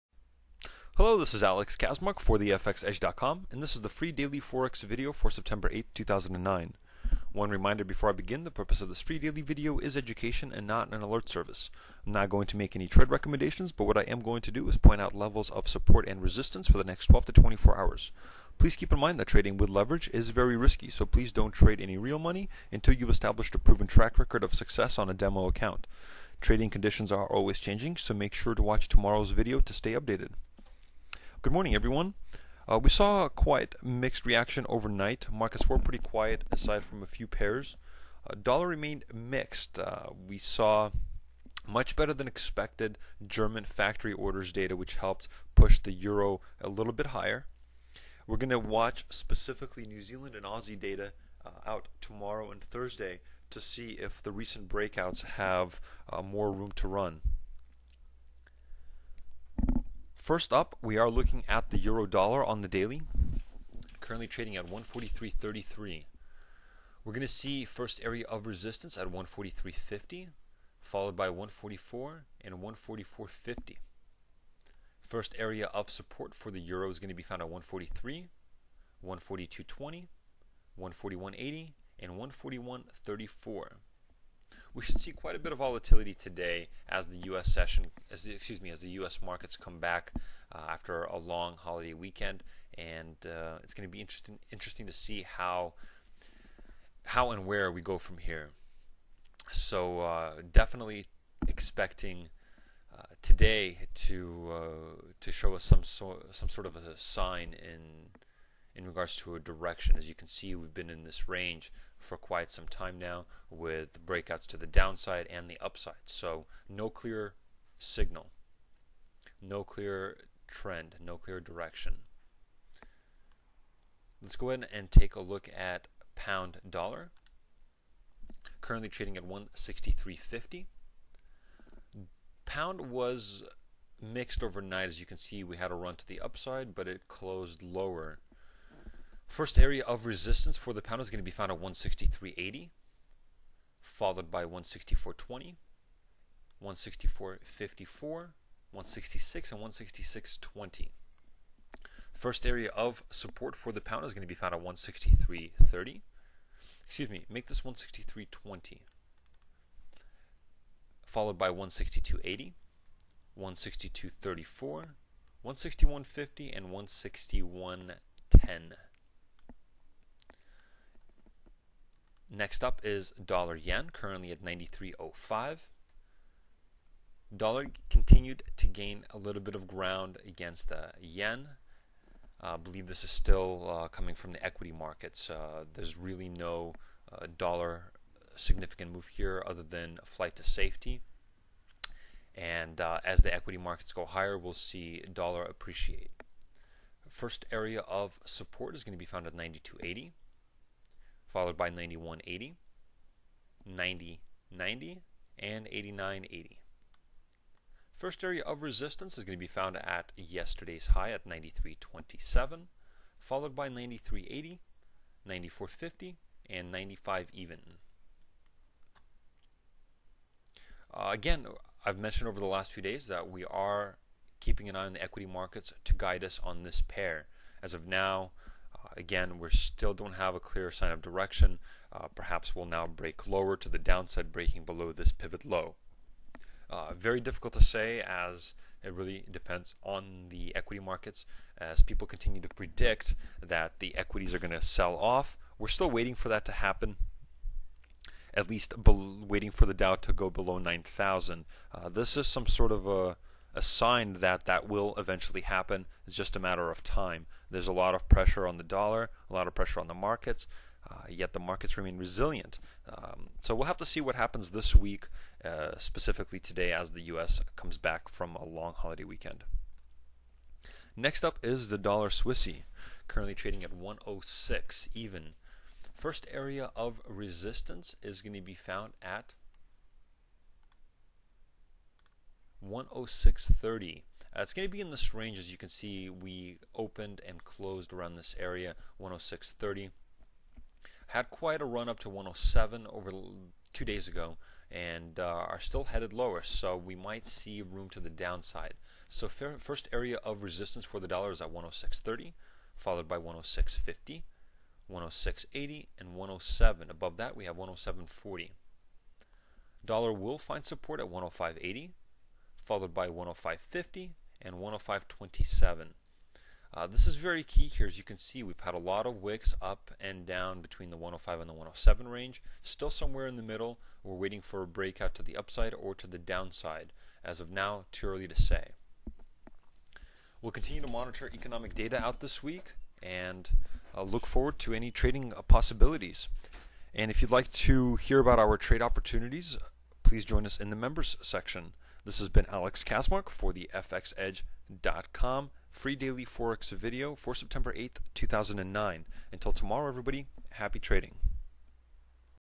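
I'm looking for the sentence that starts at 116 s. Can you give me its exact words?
So, no clear signal, no clear trend, no clear direction.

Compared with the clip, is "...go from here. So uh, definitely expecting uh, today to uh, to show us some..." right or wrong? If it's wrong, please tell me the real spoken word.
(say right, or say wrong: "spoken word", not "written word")
right.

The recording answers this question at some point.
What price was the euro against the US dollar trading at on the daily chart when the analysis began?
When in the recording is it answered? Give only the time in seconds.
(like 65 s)
64 s.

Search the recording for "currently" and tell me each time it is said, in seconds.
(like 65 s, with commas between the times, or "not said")
63 s, 128 s, 173 s, 273 s.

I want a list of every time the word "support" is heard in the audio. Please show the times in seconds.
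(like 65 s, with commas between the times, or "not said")
15 s, 75 s, 198 s, 310 s.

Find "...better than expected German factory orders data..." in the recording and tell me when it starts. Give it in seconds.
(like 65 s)
41 s.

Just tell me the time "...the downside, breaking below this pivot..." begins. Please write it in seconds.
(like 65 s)
233 s.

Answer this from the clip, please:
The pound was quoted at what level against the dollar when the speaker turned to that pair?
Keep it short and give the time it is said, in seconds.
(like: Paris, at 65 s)
163.50, at 129 s.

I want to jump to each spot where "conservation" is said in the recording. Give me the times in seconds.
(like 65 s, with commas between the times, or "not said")
not said.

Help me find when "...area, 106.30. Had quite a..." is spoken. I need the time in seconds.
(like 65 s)
288 s.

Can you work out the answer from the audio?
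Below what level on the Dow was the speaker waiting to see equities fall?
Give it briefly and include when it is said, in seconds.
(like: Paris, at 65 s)
9,000, at 250 s.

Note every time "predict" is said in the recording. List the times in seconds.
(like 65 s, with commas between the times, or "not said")
242 s.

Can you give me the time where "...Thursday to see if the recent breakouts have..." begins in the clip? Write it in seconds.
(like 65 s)
52 s.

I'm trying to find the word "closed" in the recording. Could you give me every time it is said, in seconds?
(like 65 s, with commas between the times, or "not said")
137 s, 287 s.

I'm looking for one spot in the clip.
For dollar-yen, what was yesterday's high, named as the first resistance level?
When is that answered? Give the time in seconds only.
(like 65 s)
211 s.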